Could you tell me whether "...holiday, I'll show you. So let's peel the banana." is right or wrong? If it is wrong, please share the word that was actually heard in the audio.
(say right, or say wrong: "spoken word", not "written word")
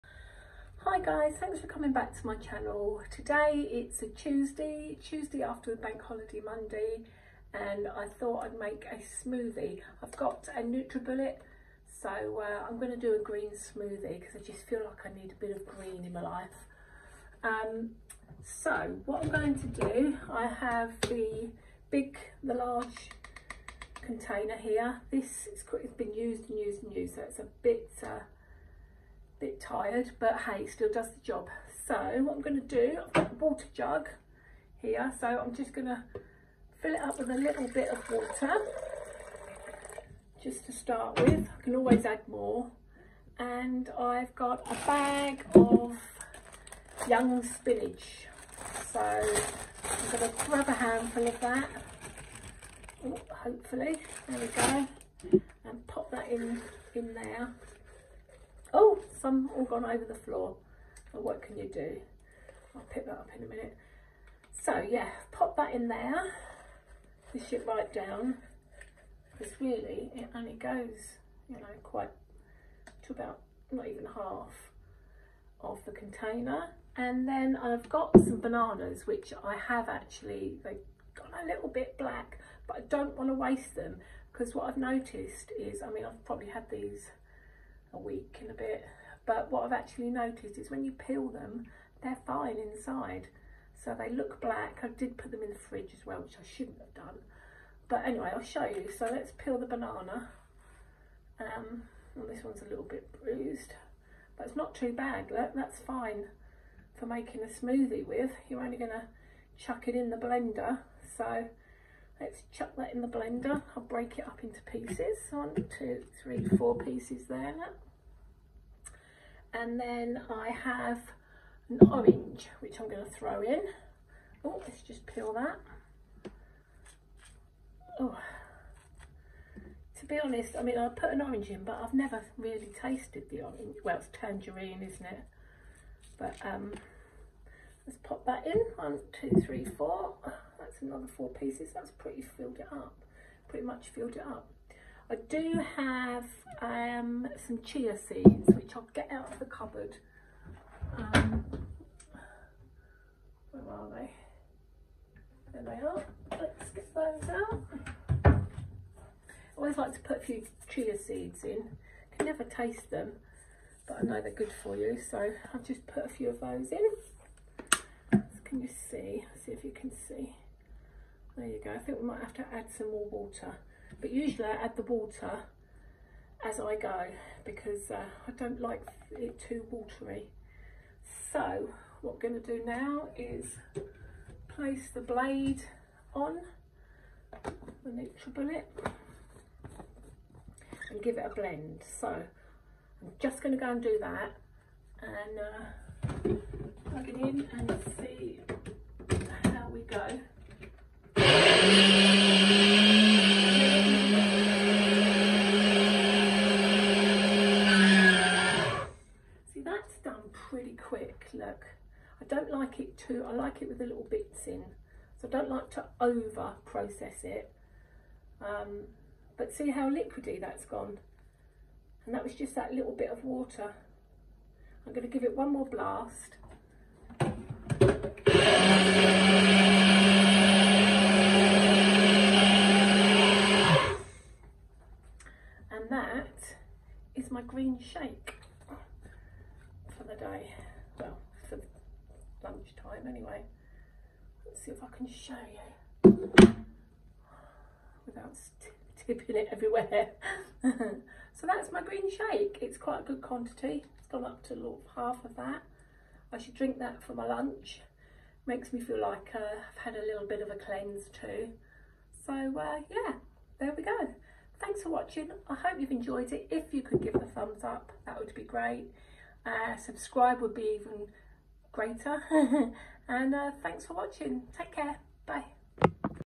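wrong: "anyway", not "holiday".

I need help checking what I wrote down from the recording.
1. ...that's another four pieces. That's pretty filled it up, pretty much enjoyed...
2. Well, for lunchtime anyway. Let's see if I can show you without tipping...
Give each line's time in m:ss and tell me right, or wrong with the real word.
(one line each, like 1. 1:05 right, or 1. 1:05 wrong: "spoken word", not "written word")
1. 2:20 wrong: "filled", not "enjoyed"
2. 4:00 right.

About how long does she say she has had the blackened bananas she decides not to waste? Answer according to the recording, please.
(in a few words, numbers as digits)
a week and a bit.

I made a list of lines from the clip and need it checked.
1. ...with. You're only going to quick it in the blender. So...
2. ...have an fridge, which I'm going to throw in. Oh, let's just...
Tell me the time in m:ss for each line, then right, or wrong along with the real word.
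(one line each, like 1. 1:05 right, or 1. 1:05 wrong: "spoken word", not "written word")
1. 1:48 wrong: "chuck", not "quick"
2. 2:00 wrong: "orange", not "fridge".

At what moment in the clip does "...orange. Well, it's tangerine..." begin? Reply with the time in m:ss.
2:13.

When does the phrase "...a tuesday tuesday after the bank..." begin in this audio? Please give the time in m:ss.
0:04.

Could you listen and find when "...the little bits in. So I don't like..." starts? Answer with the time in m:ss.
3:33.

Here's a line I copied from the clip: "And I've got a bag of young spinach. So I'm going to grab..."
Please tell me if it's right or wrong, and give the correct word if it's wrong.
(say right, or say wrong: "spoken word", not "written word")
right.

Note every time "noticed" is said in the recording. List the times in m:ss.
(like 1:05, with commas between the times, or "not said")
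1:24, 1:30.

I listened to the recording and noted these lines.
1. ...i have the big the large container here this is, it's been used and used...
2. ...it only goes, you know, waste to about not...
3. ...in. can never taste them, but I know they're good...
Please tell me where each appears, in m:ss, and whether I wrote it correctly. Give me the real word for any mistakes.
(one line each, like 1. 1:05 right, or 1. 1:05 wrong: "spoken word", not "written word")
1. 0:20 right
2. 1:10 wrong: "quite", not "waste"
3. 2:41 right.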